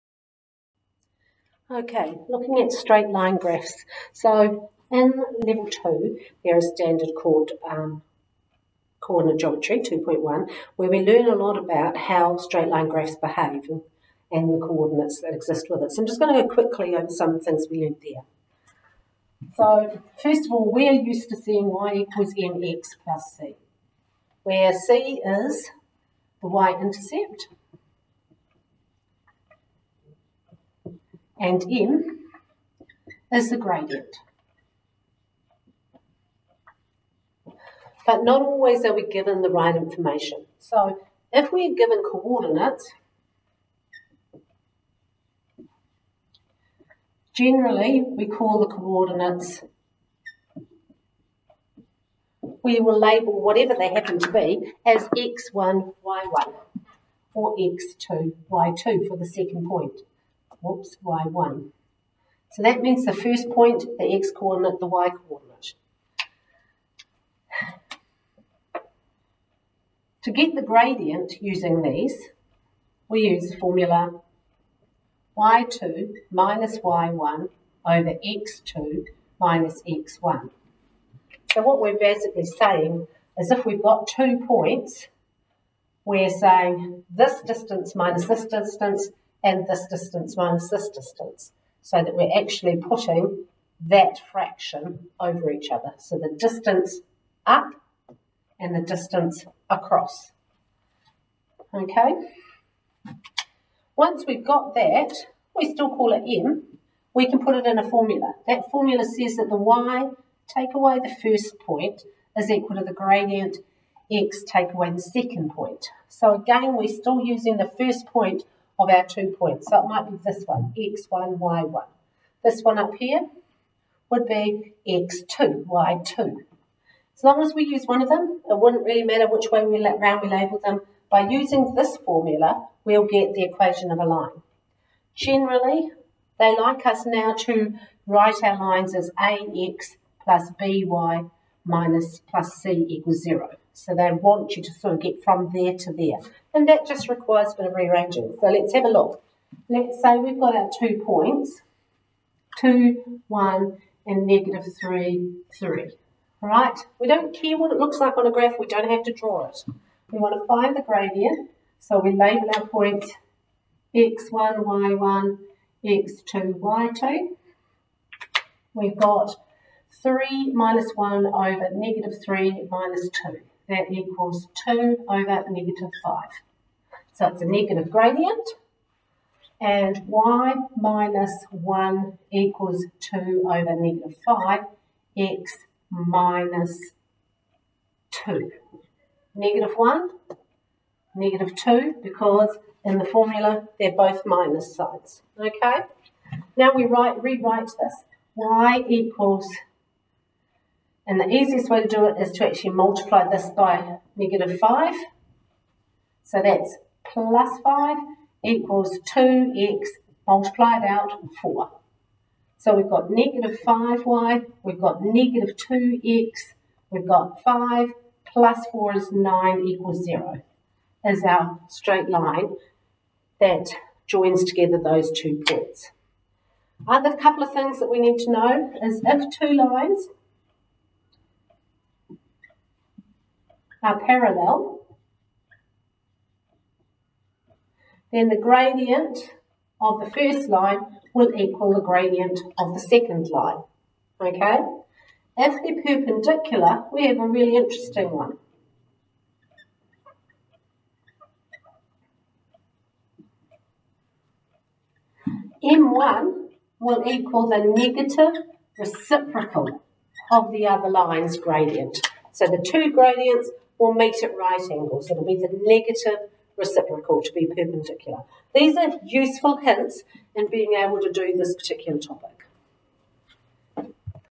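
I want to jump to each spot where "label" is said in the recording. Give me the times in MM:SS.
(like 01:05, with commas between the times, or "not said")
00:52, 02:10, 02:42.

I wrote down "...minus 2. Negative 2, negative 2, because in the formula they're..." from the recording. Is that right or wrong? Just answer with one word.
wrong.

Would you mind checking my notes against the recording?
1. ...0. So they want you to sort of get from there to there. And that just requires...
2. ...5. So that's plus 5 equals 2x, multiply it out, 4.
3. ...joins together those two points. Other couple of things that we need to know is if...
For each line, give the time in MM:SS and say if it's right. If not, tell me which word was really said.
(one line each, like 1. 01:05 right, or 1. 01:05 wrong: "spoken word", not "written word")
1. 02:23 right
2. 03:24 right
3. 03:44 right.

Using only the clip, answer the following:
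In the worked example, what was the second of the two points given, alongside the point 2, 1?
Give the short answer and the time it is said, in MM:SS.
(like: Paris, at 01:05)
-3, 3, at 02:34.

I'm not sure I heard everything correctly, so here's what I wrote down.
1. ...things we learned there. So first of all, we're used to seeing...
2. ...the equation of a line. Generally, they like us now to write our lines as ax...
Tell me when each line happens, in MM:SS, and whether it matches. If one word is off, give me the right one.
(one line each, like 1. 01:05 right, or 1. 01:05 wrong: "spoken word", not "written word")
1. 00:17 right
2. 02:13 right.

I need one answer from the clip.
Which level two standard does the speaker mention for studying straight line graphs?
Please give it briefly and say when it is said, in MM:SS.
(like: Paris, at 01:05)
Geometry 2.1, at 00:09.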